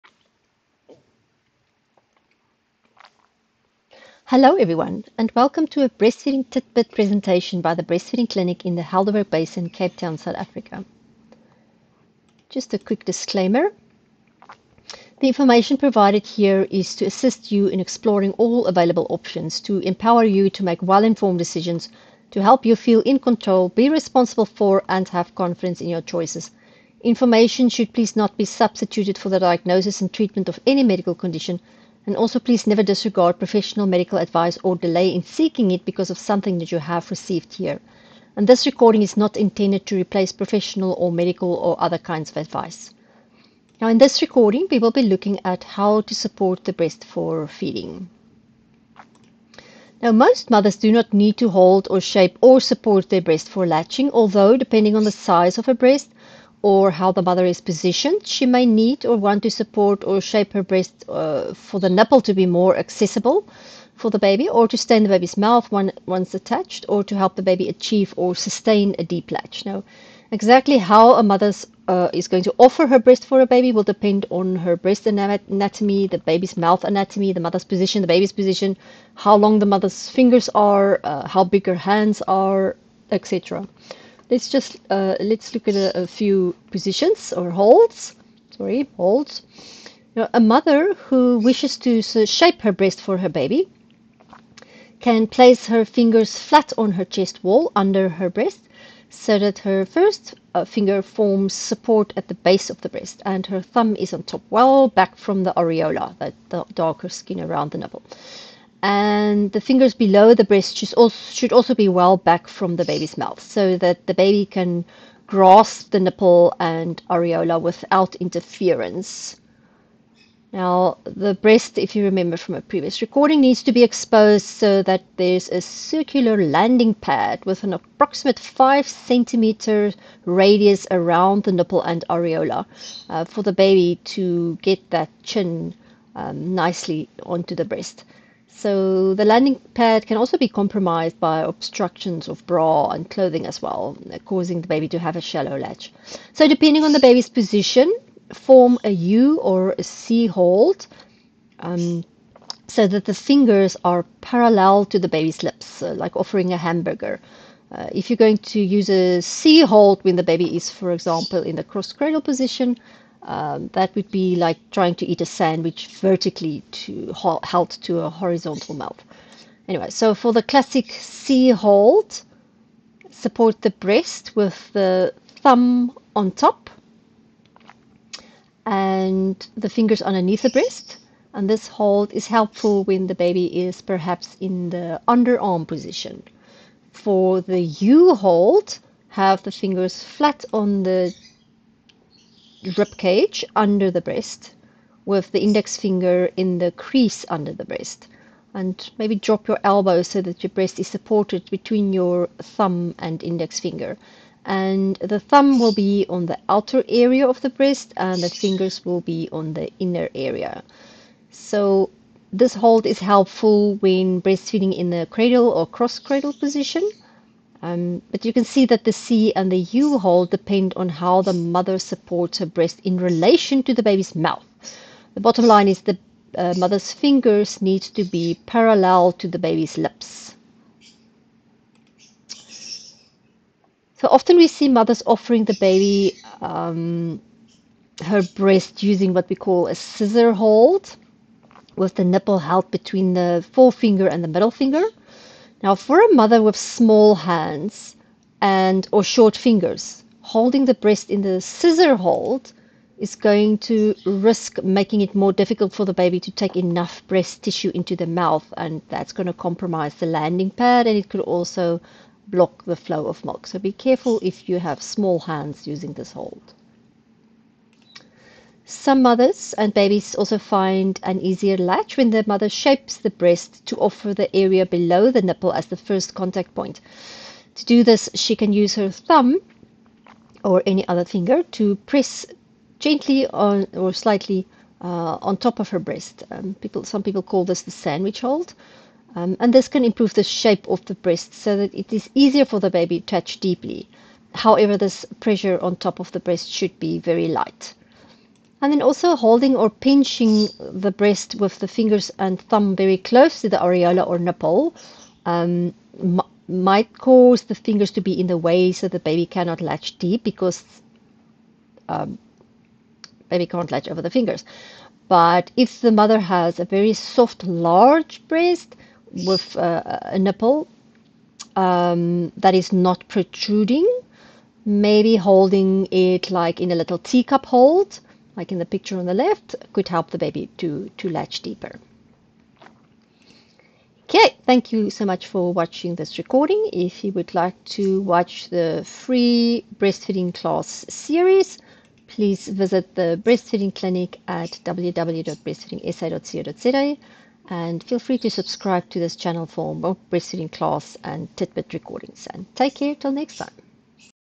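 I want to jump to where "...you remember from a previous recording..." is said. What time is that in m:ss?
2:01.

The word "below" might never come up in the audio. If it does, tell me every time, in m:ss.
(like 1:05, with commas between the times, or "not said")
1:49, 4:34.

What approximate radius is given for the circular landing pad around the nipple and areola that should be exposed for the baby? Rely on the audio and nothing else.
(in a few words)
5 centimeters.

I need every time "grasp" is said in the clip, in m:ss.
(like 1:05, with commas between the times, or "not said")
1:55.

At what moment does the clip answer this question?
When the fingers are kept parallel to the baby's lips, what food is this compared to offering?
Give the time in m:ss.
2:36.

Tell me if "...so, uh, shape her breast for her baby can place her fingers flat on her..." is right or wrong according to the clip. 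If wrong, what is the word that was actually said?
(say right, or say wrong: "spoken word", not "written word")
right.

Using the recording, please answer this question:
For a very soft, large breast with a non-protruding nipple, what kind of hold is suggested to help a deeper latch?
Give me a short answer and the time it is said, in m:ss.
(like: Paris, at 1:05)
Teacup hold, at 5:26.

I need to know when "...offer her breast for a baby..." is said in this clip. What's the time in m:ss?
1:12.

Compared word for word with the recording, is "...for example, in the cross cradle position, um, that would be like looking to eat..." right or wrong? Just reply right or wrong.
wrong.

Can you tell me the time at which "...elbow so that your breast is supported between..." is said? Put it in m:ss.
3:19.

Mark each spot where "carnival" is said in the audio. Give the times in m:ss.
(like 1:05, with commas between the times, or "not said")
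not said.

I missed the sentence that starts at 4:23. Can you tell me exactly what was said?
So be careful if you have small hands using this hold.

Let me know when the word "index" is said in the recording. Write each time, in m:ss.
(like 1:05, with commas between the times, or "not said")
3:15, 3:23.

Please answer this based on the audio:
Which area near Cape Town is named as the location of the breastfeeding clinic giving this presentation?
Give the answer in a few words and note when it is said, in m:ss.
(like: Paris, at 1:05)
Helderberg Basin, at 0:08.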